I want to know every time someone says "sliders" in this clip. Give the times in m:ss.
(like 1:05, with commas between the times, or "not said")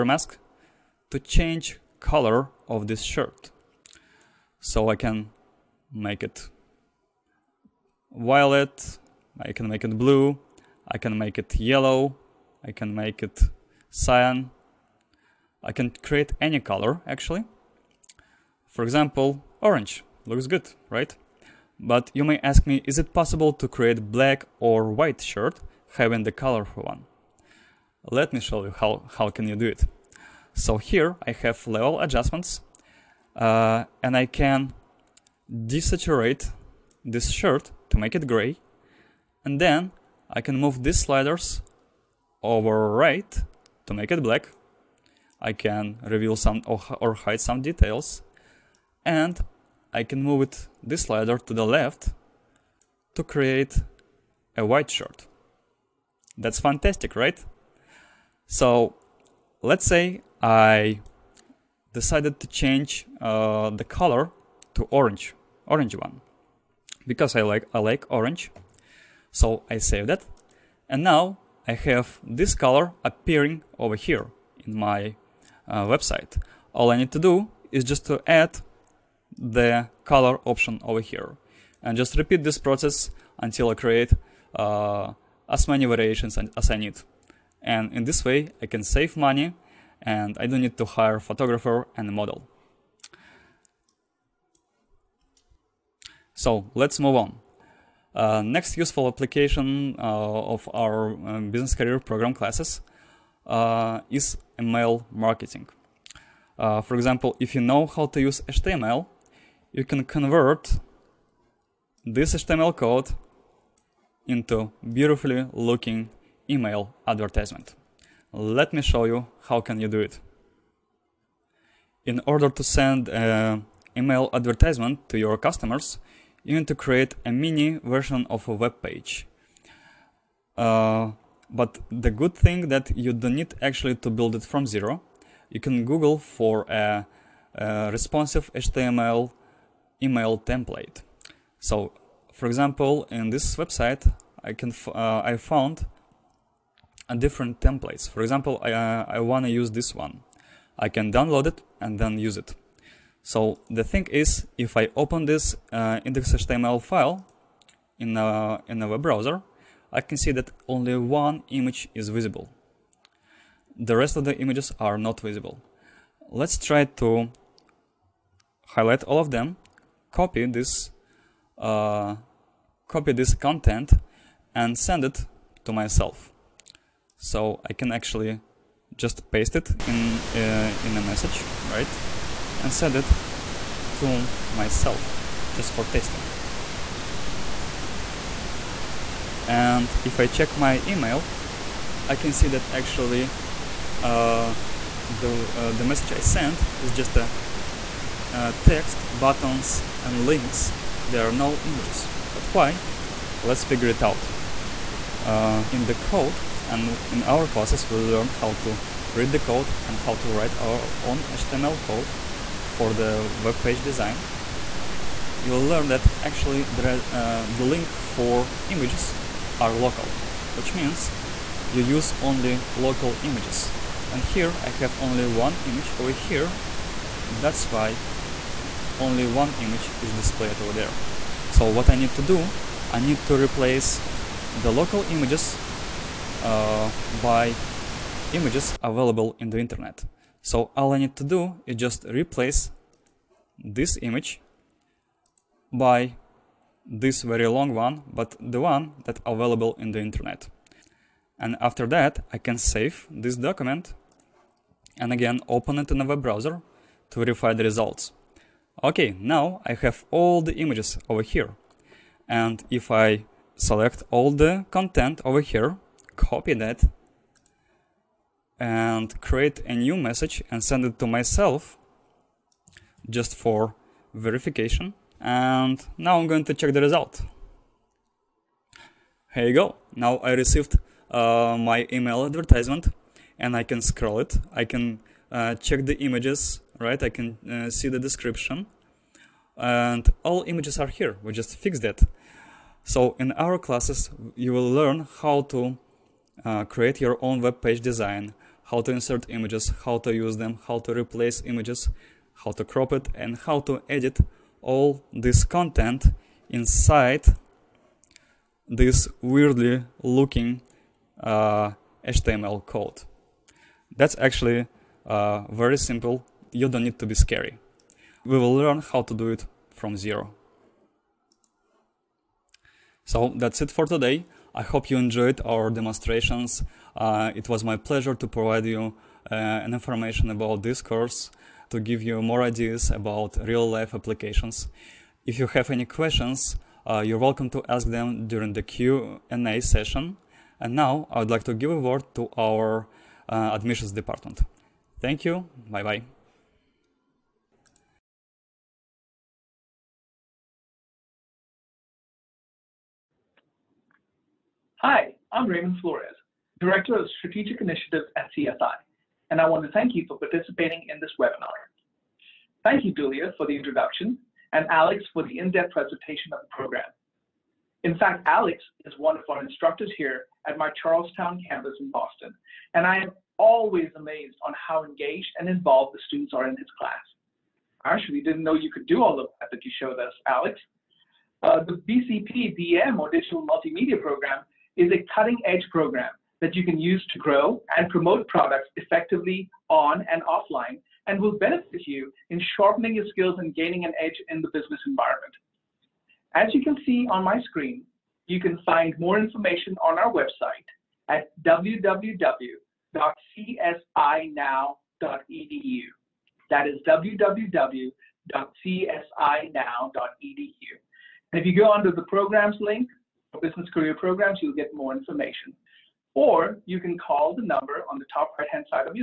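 0:41, 0:51.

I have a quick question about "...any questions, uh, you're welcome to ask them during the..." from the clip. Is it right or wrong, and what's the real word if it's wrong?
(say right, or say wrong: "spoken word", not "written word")
right.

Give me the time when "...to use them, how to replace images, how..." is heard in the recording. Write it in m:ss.
4:59.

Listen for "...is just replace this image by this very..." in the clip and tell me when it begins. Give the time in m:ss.
4:01.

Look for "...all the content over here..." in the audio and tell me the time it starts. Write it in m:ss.
4:24.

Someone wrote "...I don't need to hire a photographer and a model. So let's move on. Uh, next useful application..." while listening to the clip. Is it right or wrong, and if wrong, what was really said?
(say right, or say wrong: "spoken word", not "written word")
right.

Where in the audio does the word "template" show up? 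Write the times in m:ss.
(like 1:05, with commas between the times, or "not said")
2:20, 2:27.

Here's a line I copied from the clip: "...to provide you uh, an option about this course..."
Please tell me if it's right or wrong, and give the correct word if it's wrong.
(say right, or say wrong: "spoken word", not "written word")
wrong: "information", not "option".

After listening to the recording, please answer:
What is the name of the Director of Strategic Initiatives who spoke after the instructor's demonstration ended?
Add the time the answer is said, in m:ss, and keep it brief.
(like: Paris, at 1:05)
Raymond Flores, at 5:55.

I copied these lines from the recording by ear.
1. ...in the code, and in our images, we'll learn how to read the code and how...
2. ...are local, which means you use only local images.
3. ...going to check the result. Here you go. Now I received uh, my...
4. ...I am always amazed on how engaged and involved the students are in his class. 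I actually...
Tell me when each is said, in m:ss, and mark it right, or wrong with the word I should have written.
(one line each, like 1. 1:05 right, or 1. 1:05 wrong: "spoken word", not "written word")
1. 3:25 wrong: "classes", not "images"
2. 3:39 right
3. 4:36 right
4. 6:12 right.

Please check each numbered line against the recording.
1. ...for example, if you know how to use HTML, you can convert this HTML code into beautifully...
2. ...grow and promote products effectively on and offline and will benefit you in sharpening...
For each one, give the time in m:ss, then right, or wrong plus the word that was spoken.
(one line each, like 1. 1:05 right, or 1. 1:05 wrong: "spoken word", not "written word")
1. 1:46 right
2. 6:27 right.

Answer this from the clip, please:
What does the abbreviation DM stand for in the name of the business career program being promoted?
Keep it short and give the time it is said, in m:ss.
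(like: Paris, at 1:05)
Digital Multimedia, at 6:23.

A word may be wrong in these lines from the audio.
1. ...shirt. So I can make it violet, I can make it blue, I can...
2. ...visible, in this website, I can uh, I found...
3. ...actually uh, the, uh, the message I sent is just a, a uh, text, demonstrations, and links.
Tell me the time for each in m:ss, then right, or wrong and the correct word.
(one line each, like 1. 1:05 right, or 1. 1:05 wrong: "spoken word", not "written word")
1. 0:03 right
2. 2:22 wrong: "example", not "visible"
3. 3:12 wrong: "buttons", not "demonstrations".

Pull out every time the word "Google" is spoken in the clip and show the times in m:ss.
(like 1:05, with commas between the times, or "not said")
2:15.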